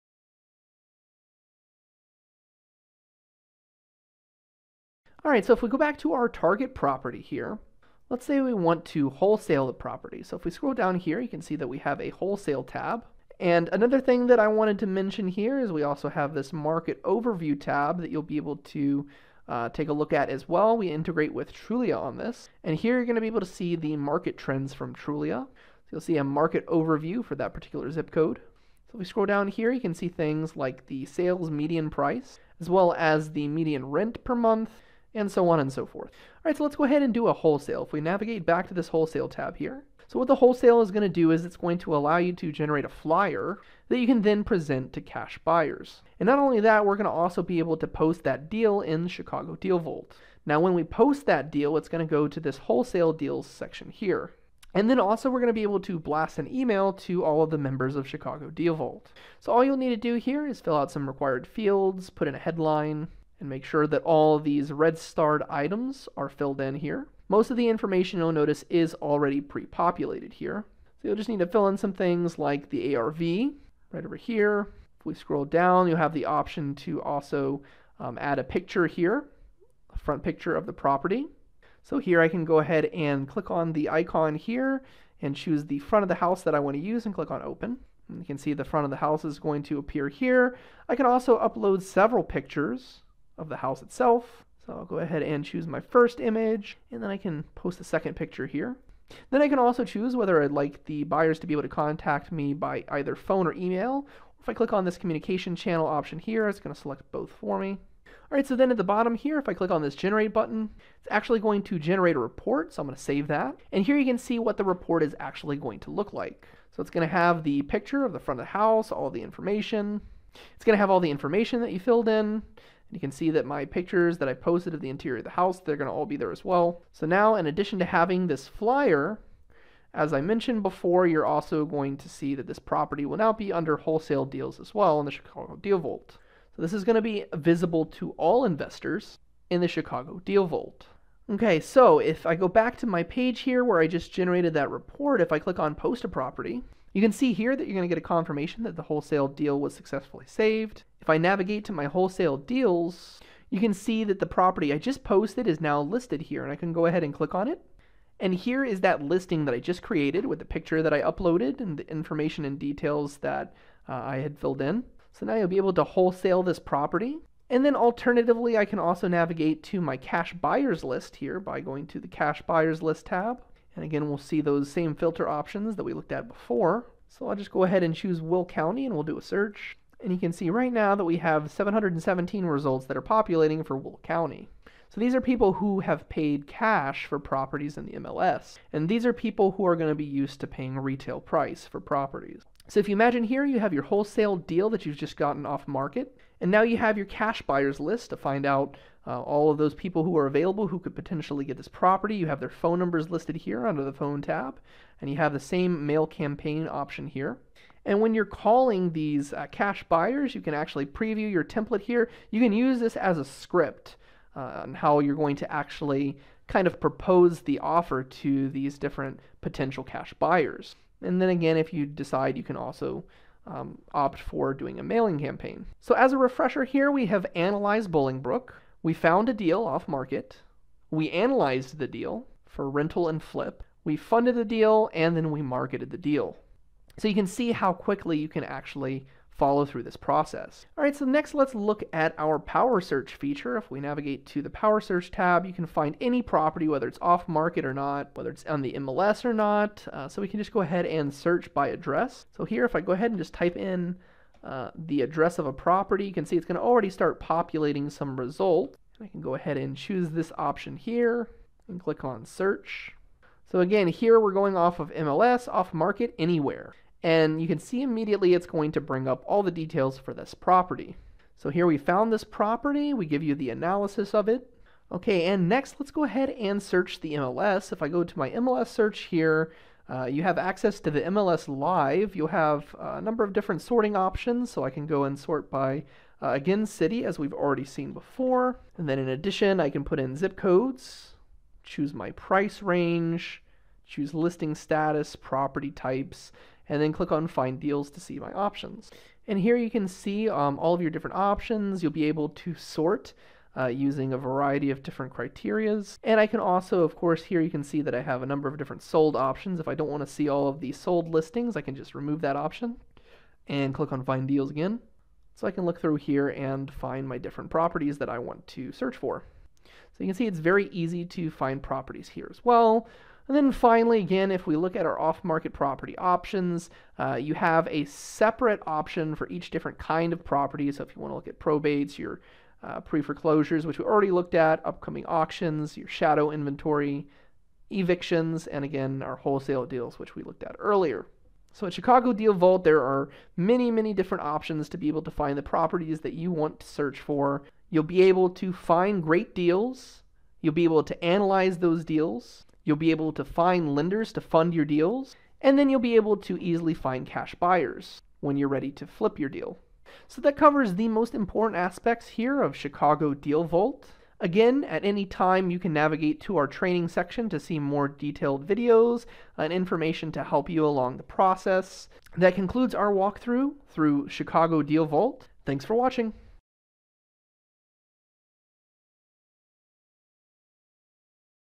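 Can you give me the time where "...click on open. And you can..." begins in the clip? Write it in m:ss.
1:27.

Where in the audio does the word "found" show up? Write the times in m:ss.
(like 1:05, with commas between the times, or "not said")
3:48, 4:31.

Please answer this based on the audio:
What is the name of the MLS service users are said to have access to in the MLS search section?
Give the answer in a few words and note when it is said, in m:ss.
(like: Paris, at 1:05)
MLS Live, at 4:41.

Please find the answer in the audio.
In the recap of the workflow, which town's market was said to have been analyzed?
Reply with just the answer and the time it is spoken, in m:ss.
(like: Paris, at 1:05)
Bolingbrook, at 3:47.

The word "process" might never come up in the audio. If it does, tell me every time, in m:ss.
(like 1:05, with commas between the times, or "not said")
3:59, 6:11.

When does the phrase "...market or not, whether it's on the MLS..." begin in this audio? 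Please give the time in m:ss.
4:07.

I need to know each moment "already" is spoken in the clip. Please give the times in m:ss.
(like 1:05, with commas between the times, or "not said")
1:08, 4:16, 4:47, 5:33.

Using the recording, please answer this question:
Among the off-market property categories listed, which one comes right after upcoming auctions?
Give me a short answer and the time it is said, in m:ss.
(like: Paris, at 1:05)
shadow inventory, at 5:35.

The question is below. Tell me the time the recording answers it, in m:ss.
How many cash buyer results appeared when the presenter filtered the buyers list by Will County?
3:01.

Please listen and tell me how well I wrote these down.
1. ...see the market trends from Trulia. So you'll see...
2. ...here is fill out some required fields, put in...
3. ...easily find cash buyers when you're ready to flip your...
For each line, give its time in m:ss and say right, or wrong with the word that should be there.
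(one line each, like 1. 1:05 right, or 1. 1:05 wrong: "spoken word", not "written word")
1. 0:23 right
2. 1:00 right
3. 5:56 right.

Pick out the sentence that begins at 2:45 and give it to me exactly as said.
So now you'll be able to wholesale this property.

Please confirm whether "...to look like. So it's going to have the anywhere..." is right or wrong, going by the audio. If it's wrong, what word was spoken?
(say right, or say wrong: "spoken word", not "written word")
wrong: "picture", not "anywhere".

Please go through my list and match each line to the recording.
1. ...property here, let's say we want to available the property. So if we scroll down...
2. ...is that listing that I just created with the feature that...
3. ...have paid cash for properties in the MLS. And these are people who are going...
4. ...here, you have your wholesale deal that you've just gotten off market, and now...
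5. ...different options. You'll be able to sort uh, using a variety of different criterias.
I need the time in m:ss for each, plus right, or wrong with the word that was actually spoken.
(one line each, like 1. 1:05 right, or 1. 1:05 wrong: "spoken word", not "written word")
1. 0:06 wrong: "wholesale", not "available"
2. 2:38 wrong: "picture", not "feature"
3. 3:05 right
4. 3:13 right
5. 5:00 right.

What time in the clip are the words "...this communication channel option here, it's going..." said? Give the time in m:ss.
1:44.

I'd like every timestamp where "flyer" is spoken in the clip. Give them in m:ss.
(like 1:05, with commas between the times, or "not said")
0:42, 2:08.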